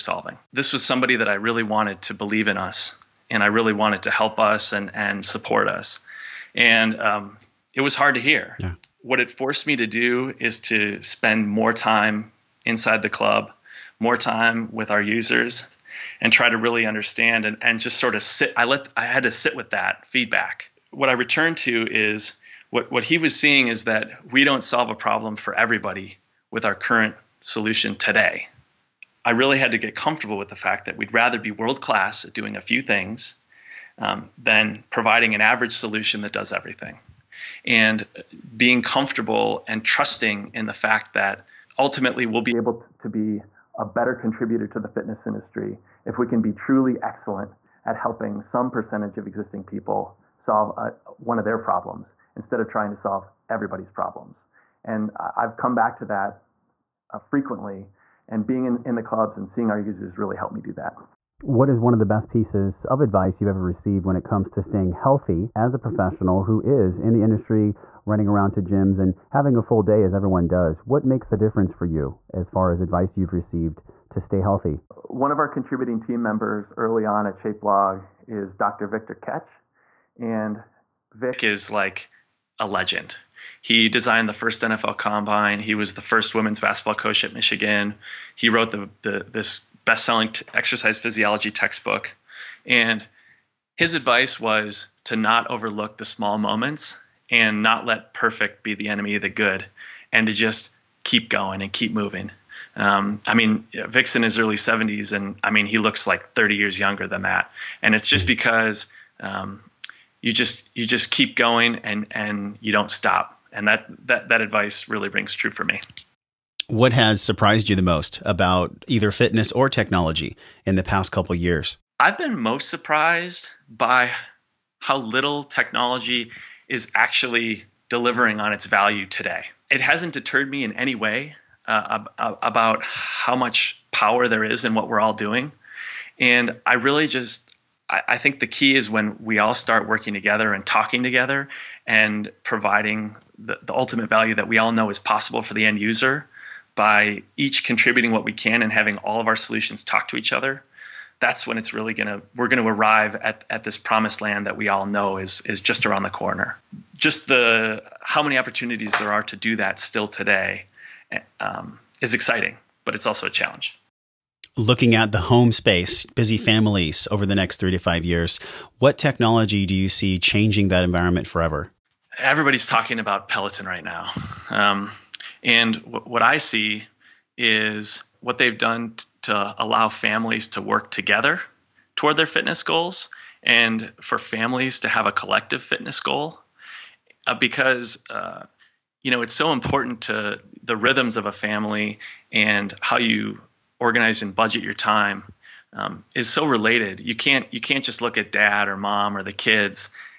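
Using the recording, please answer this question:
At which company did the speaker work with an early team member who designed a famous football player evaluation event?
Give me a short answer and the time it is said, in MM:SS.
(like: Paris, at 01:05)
ShapeLog, at 01:17.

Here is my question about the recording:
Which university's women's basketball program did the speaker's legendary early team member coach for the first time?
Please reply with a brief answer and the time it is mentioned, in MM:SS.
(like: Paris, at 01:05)
Michigan, at 01:27.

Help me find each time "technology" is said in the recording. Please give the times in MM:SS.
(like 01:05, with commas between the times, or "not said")
01:59, 02:05, 02:48.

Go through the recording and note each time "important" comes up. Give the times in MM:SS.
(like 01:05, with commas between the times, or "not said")
03:09.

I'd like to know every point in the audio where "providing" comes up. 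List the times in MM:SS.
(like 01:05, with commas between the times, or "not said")
00:34, 02:22.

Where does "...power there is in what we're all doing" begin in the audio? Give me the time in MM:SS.
02:13.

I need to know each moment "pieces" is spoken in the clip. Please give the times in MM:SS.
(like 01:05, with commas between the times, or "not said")
01:02.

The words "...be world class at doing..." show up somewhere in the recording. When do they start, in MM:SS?
00:31.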